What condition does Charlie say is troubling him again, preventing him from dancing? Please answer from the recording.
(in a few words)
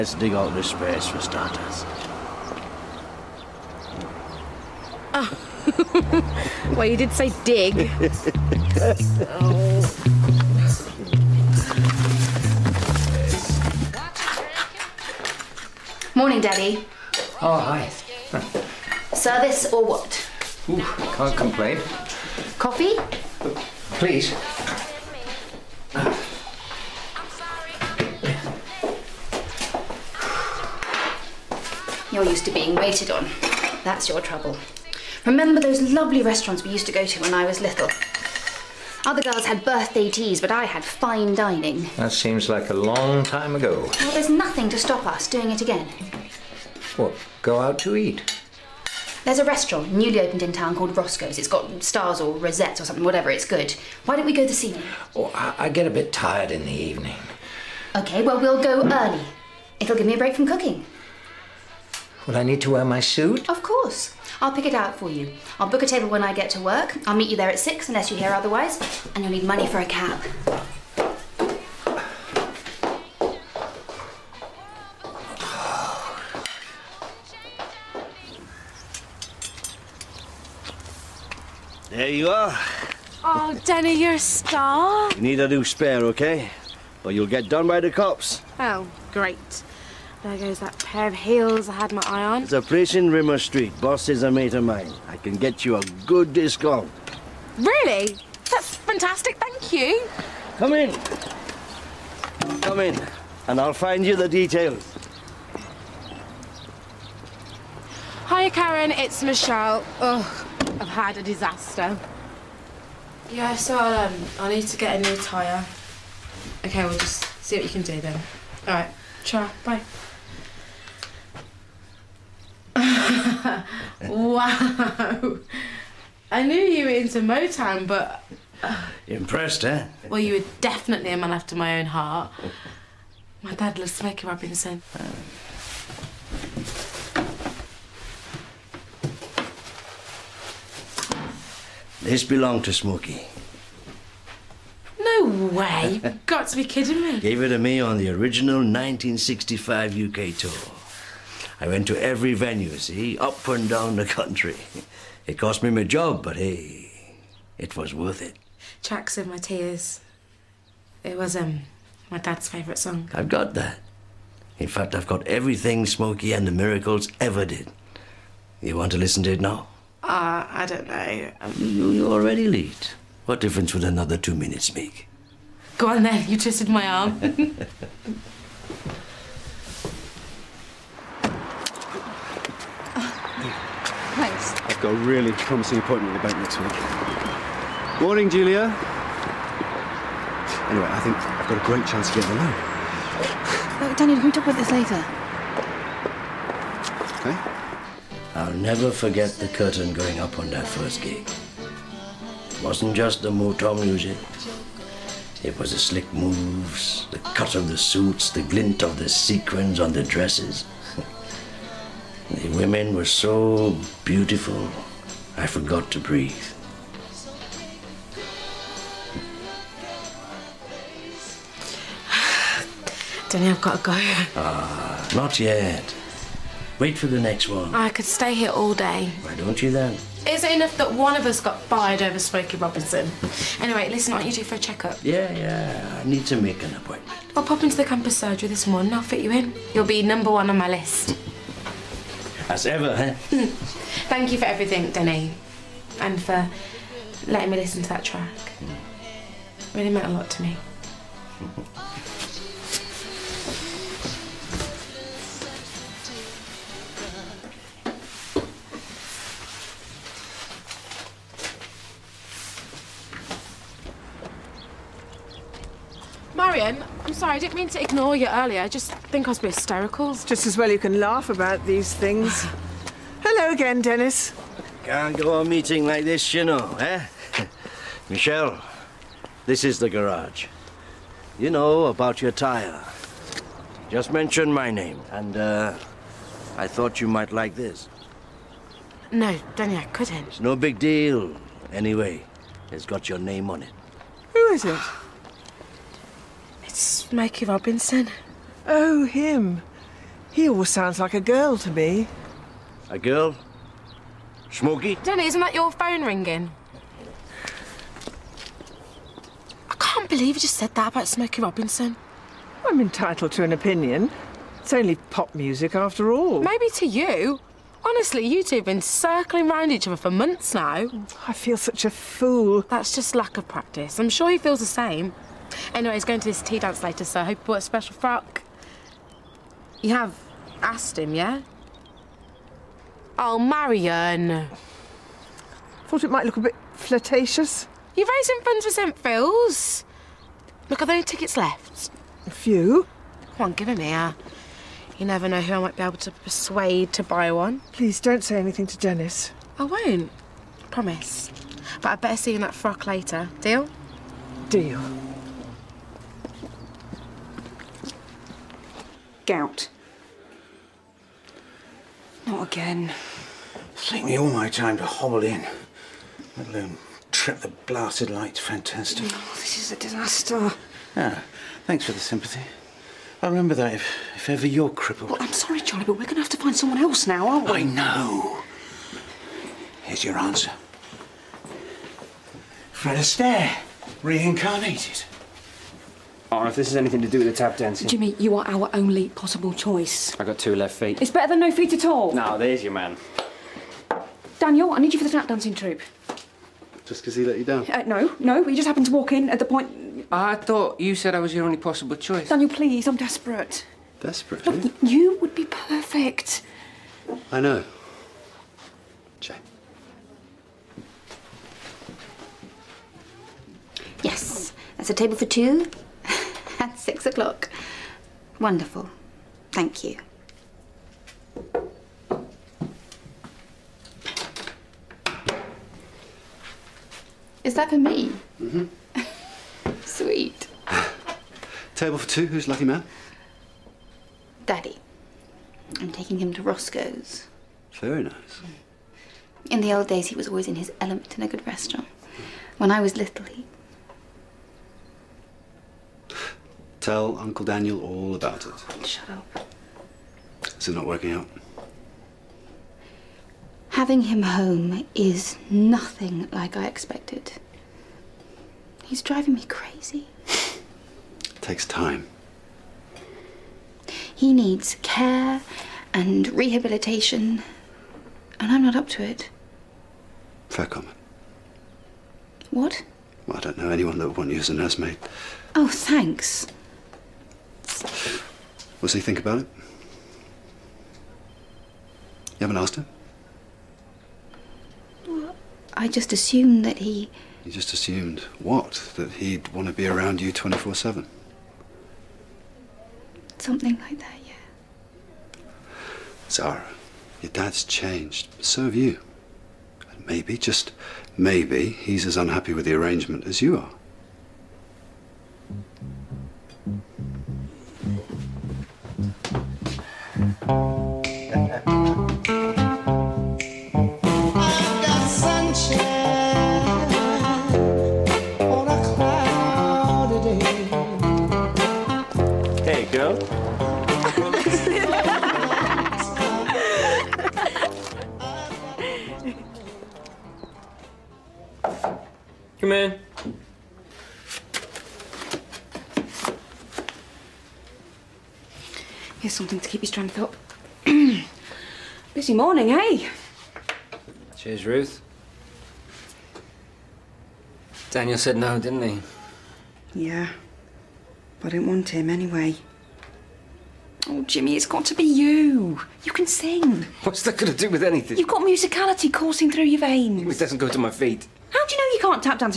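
gout.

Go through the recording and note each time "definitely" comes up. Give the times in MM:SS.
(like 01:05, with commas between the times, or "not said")
02:10.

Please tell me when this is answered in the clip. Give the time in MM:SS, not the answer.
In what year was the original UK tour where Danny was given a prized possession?
02:28.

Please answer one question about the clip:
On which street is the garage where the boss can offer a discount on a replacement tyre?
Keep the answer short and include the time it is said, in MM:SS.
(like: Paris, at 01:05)
Rimmer Street, at 01:33.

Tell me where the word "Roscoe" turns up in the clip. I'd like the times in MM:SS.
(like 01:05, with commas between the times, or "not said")
00:50, 07:16.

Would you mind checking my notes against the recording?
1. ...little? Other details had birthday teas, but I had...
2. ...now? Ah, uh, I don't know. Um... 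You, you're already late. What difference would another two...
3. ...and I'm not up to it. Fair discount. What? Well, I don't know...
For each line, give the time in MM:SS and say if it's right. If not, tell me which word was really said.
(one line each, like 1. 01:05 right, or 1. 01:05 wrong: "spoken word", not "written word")
1. 00:37 wrong: "girls", not "details"
2. 02:49 right
3. 07:48 wrong: "comment", not "discount".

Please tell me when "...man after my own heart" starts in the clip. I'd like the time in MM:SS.
02:11.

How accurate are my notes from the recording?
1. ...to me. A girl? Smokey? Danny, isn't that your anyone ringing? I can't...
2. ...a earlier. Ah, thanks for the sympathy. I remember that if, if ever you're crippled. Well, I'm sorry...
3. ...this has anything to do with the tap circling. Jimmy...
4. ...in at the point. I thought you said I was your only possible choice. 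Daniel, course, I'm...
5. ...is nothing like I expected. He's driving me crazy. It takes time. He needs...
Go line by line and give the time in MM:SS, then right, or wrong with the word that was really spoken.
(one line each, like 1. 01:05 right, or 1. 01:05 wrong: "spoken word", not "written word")
1. 05:01 wrong: "phone", not "anyone"
2. 06:09 wrong: "disaster", not "earlier"
3. 06:26 wrong: "dancing", not "circling"
4. 06:39 wrong: "please", not "course"
5. 07:34 right.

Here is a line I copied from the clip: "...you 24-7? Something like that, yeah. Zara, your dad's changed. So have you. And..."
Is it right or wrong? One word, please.
right.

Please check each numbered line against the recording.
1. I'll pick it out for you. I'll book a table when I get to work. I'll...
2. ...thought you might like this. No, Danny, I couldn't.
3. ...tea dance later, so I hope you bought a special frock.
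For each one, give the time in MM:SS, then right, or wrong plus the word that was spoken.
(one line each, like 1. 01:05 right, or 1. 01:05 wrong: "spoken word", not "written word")
1. 01:04 right
2. 04:46 right
3. 05:26 right.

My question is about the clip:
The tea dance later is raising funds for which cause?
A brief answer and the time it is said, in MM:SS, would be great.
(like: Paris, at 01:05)
St Phil's, at 05:38.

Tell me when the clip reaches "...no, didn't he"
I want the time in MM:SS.
09:08.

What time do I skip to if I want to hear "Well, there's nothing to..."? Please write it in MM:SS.
00:43.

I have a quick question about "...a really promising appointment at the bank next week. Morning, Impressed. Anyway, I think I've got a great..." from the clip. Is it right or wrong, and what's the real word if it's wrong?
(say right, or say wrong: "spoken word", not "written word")
wrong: "Julia", not "Impressed".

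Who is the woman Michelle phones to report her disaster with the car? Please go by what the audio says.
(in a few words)
Karen.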